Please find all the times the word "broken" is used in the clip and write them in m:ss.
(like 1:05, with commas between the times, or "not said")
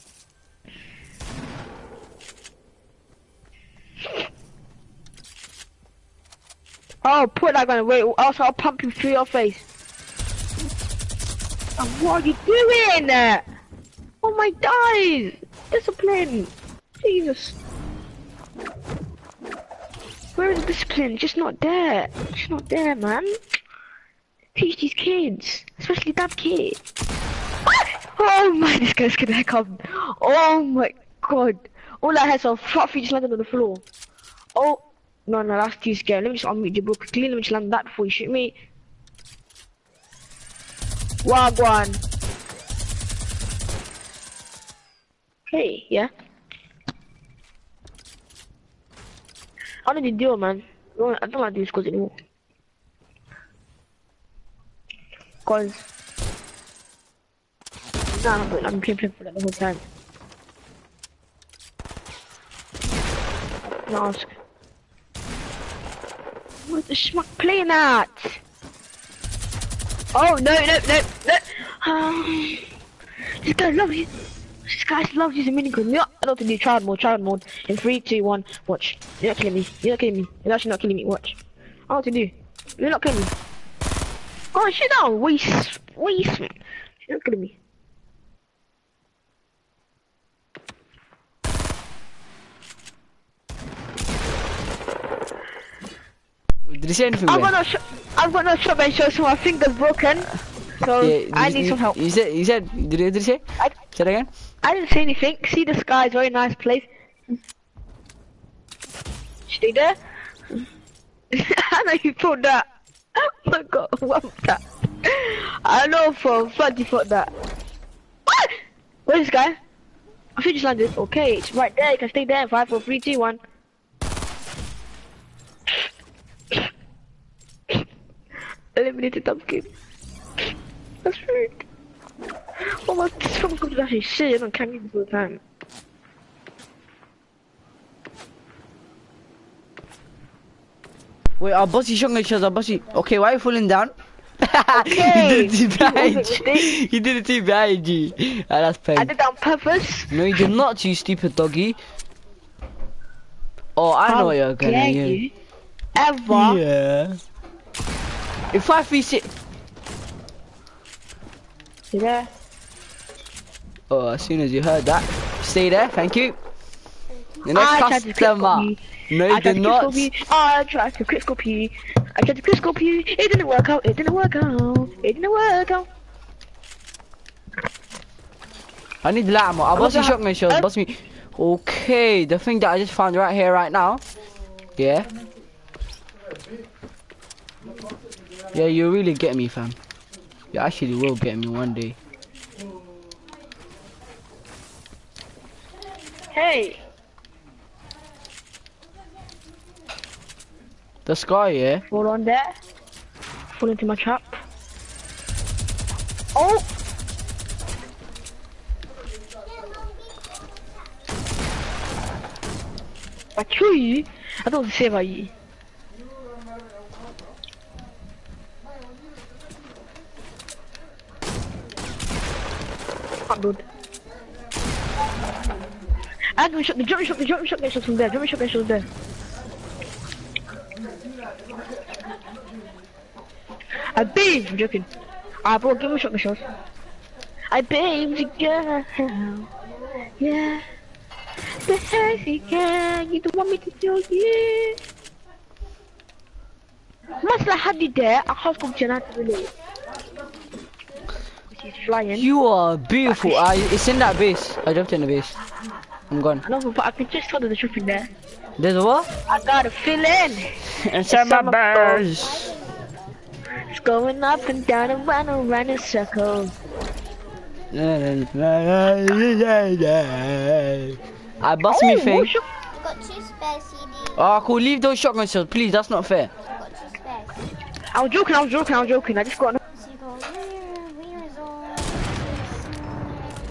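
1:39.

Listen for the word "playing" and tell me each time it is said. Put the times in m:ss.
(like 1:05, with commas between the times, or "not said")
0:58, 1:07.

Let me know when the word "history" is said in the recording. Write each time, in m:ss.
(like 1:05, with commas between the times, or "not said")
not said.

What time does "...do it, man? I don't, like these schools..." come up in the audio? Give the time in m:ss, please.
0:50.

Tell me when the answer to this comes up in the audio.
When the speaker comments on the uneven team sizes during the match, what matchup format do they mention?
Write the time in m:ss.
2:38.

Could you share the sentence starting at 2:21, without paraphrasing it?
Wait, our bossy shot each other, bossy.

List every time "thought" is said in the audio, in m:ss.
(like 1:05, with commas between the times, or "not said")
1:52, 1:56.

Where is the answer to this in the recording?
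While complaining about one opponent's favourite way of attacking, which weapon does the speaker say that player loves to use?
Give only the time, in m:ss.
1:15.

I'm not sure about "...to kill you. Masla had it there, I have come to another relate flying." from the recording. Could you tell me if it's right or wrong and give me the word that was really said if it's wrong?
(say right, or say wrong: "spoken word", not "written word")
right.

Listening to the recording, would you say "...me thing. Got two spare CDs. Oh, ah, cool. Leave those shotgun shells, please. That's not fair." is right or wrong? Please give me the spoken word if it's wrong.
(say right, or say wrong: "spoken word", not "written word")
right.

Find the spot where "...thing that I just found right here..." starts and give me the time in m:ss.
3:02.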